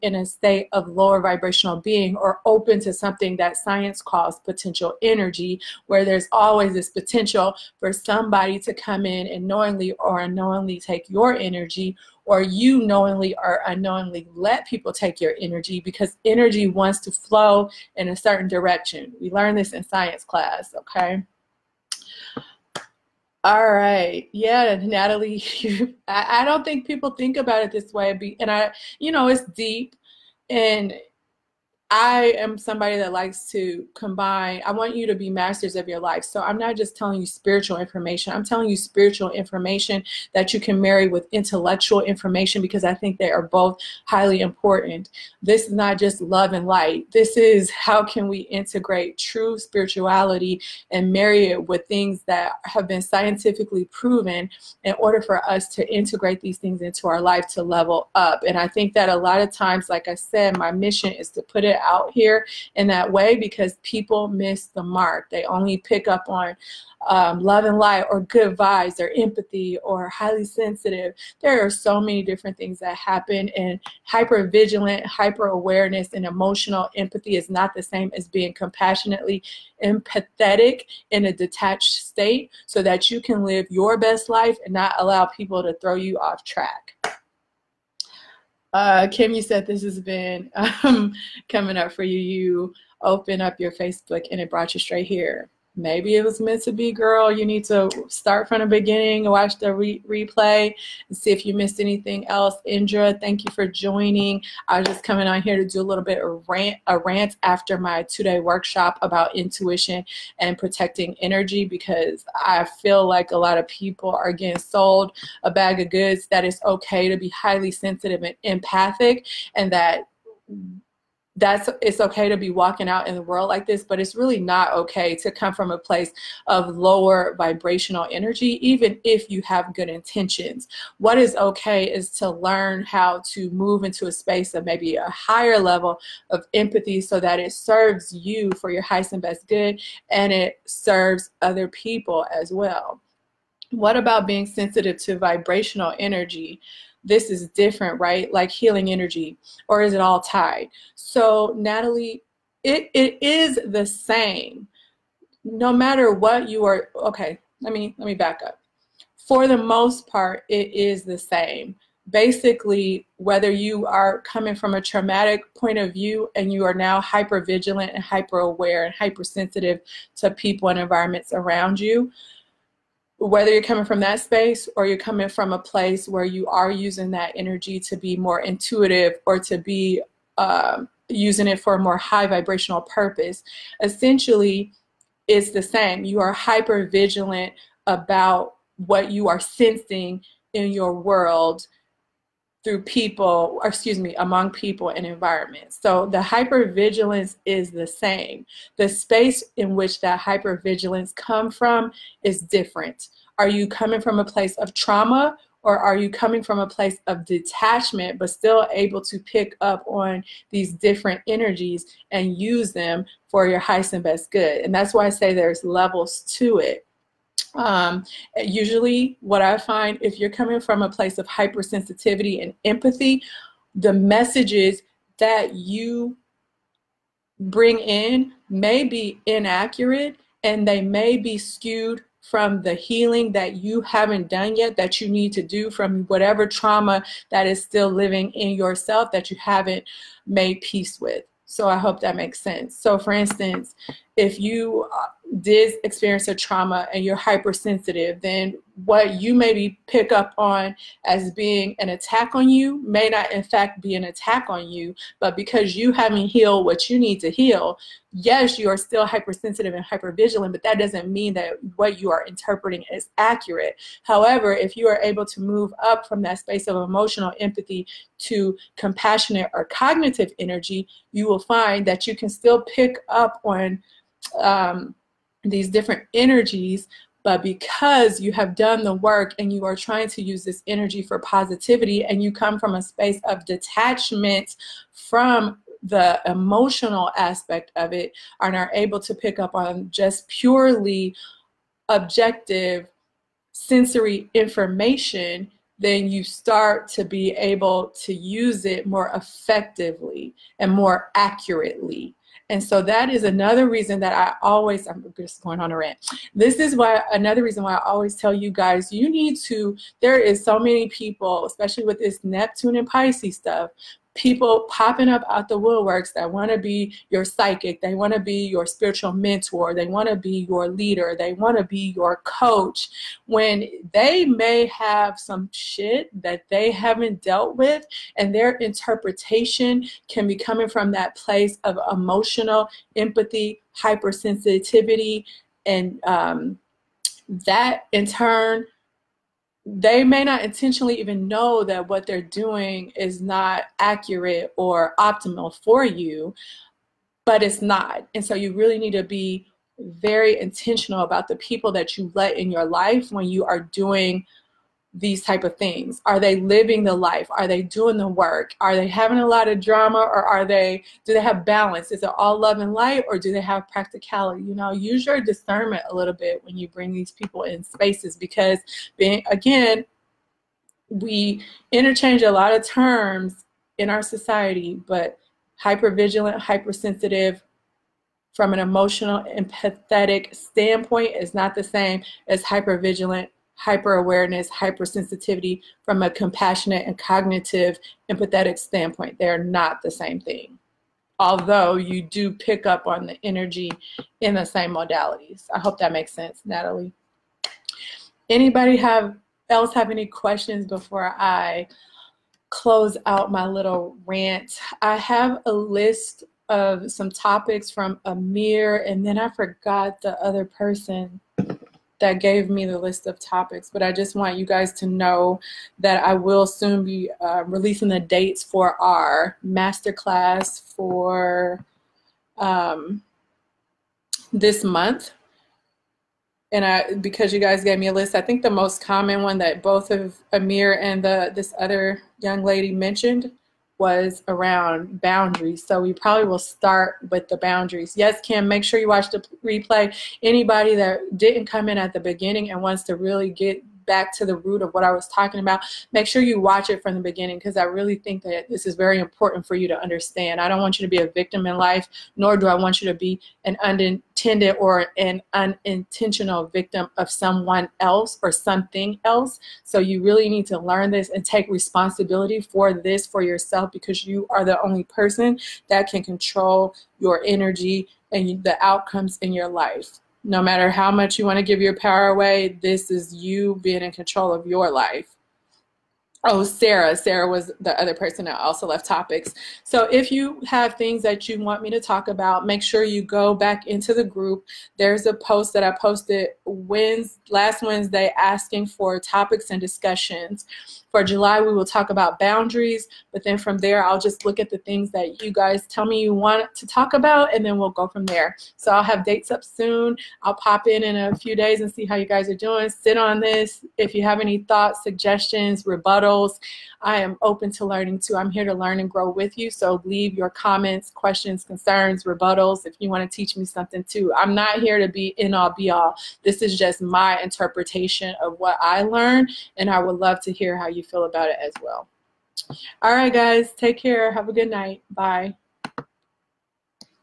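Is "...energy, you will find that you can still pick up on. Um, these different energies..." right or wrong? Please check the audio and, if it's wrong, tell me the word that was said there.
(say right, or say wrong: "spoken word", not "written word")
right.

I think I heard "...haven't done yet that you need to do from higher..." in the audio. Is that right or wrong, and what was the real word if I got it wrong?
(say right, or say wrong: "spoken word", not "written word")
wrong: "whatever", not "higher".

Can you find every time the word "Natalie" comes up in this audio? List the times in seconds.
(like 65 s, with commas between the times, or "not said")
24 s, 151 s, 396 s.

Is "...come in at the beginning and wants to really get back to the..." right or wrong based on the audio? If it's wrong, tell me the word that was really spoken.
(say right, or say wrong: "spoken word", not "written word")
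right.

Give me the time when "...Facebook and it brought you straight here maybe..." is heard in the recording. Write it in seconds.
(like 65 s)
93 s.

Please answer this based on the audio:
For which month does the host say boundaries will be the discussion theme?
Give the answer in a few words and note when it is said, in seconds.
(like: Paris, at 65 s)
July, at 491 s.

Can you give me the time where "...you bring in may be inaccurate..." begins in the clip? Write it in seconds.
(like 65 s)
225 s.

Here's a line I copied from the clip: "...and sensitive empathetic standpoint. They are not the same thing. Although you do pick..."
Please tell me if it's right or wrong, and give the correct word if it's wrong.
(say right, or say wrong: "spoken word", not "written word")
wrong: "cognitive", not "sensitive".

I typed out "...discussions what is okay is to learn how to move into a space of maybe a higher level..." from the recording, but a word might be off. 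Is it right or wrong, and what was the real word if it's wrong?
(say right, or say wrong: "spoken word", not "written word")
wrong: "intentions", not "discussions".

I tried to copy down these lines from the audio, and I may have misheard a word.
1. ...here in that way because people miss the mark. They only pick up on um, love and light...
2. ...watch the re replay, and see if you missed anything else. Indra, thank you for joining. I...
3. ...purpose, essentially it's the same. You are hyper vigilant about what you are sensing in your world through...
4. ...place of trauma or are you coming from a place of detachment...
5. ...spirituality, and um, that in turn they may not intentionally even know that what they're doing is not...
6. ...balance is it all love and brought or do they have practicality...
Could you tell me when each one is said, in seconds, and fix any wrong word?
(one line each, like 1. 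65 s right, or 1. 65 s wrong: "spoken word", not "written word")
1. 62 s right
2. 99 s right
3. 182 s right
4. 204 s right
5. 333 s wrong: "hypersensitivity", not "spirituality"
6. 361 s wrong: "light", not "brought".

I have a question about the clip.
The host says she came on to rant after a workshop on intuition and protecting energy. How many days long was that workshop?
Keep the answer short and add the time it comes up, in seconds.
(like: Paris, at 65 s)
2, at 108 s.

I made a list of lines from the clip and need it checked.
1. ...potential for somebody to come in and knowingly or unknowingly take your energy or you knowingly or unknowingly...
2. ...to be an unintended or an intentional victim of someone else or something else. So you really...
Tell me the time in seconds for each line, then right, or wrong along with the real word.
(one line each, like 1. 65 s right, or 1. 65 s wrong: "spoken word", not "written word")
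1. 6 s right
2. 452 s wrong: "unintentional", not "intentional".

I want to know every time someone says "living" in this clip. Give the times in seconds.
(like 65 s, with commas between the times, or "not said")
237 s, 356 s.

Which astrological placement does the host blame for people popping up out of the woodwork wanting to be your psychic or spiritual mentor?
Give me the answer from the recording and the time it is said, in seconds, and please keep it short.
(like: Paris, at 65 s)
Neptune and Pisces, at 312 s.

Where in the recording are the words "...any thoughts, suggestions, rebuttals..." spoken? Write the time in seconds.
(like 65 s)
504 s.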